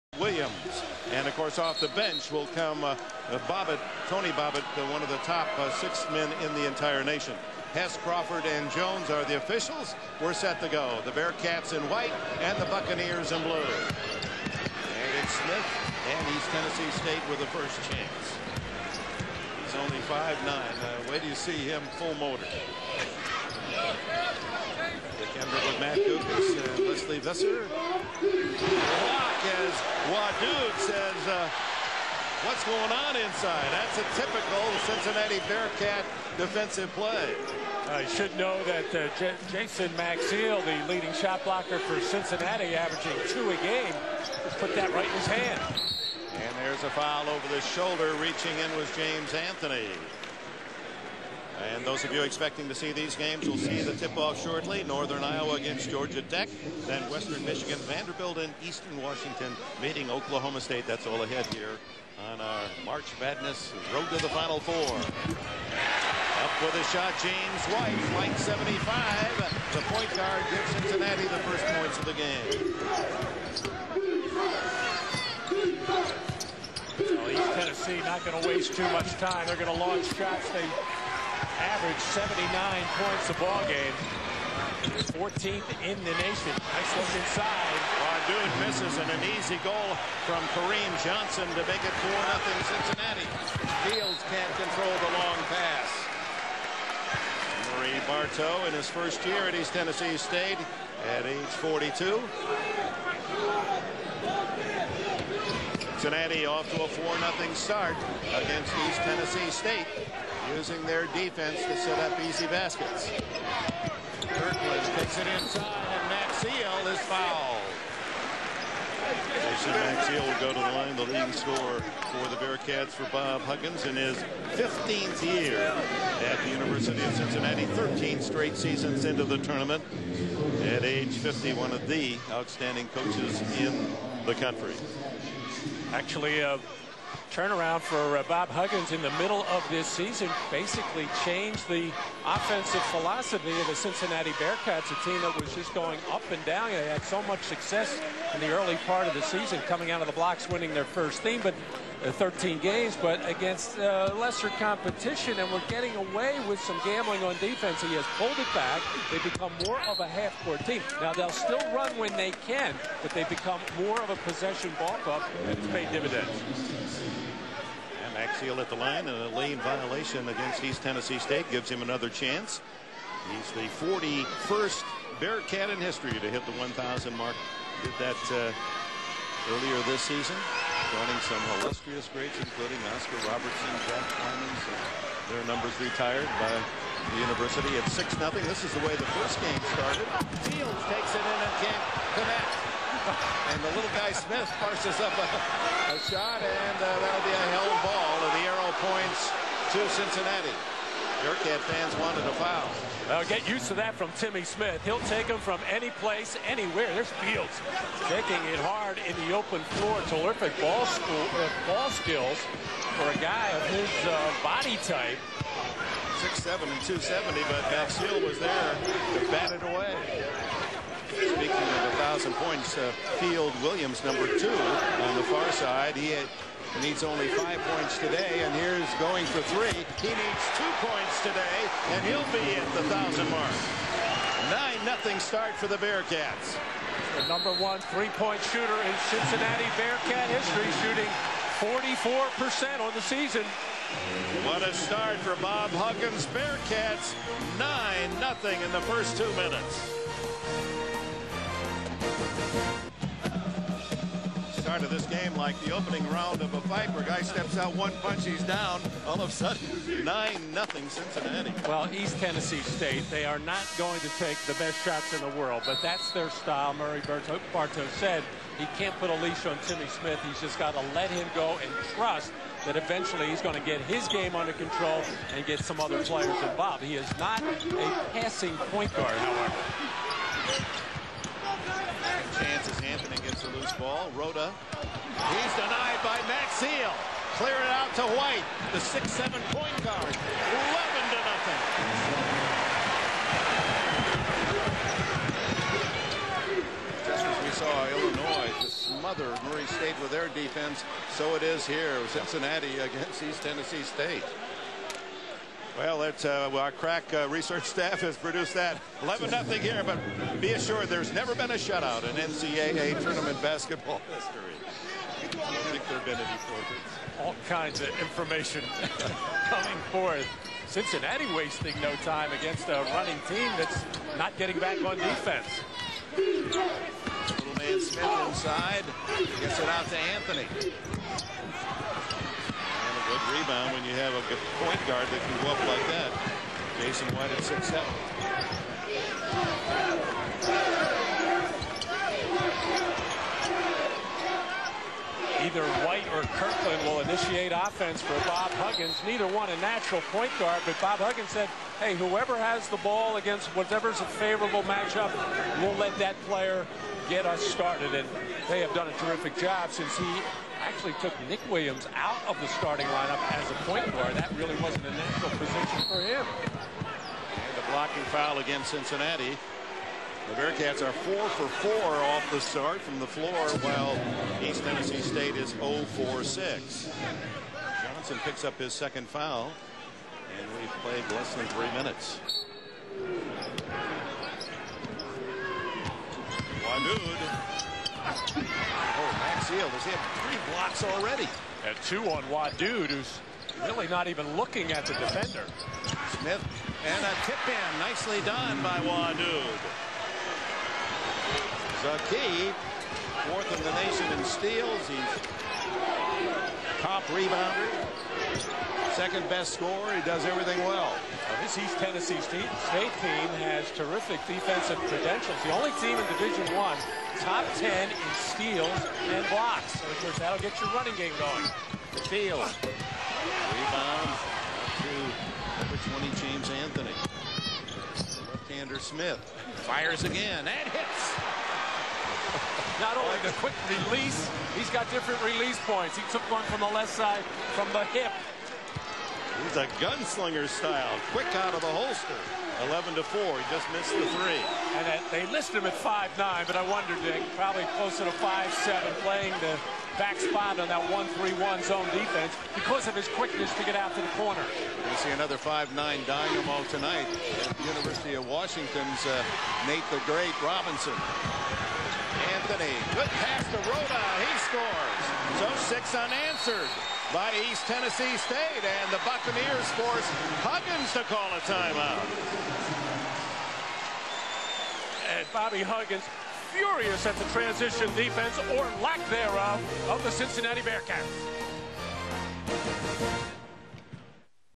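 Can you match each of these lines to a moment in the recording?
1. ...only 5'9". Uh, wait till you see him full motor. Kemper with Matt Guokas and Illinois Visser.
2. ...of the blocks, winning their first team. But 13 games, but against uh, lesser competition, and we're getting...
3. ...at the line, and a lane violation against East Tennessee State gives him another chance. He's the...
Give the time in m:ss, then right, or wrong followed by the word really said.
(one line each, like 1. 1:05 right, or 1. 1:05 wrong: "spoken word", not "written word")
1. 0:19 wrong: "Lesley", not "Illinois"
2. 2:30 right
3. 2:48 right.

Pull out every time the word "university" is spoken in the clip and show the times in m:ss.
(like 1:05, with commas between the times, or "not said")
2:06, 3:07, 7:37.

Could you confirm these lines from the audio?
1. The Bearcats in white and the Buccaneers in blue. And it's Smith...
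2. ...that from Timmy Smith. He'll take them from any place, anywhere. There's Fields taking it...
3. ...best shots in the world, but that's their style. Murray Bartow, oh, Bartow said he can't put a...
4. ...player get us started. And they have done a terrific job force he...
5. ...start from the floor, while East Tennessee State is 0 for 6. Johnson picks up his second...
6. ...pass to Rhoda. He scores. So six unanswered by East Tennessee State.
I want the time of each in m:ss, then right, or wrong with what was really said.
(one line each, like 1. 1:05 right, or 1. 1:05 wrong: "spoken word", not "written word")
1. 0:11 right
2. 3:23 right
3. 4:24 right
4. 5:56 wrong: "since", not "force"
5. 6:12 right
6. 7:43 right.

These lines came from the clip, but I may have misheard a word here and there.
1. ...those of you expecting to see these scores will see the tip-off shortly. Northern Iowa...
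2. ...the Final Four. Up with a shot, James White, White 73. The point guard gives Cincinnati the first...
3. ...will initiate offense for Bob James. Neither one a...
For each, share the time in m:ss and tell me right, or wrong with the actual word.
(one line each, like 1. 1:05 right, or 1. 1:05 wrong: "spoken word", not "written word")
1. 0:51 wrong: "games", not "scores"
2. 1:04 wrong: "75", not "73"
3. 5:46 wrong: "Huggins", not "James".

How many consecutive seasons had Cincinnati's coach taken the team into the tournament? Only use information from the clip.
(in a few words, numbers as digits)
13.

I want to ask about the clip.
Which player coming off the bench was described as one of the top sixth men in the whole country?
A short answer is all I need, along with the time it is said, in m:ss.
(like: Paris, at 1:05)
Tony Bobbitt, at 0:04.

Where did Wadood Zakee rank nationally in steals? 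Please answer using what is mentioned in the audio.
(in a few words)
fourth.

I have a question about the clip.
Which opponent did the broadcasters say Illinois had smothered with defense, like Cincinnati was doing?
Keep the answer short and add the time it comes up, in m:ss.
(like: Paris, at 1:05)
Murray State, at 4:59.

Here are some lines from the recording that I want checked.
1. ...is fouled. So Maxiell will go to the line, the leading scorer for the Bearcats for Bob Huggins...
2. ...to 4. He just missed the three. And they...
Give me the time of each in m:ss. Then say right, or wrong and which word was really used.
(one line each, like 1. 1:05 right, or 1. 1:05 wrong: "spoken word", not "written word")
1. 1:56 right
2. 7:22 right.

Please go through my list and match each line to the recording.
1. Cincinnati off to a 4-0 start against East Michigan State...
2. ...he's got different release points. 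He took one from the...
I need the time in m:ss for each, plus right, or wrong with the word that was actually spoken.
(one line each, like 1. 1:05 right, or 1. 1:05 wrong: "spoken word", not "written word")
1. 1:45 wrong: "Tennessee", not "Michigan"
2. 7:14 right.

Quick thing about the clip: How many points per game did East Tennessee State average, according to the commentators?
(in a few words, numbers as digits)
79.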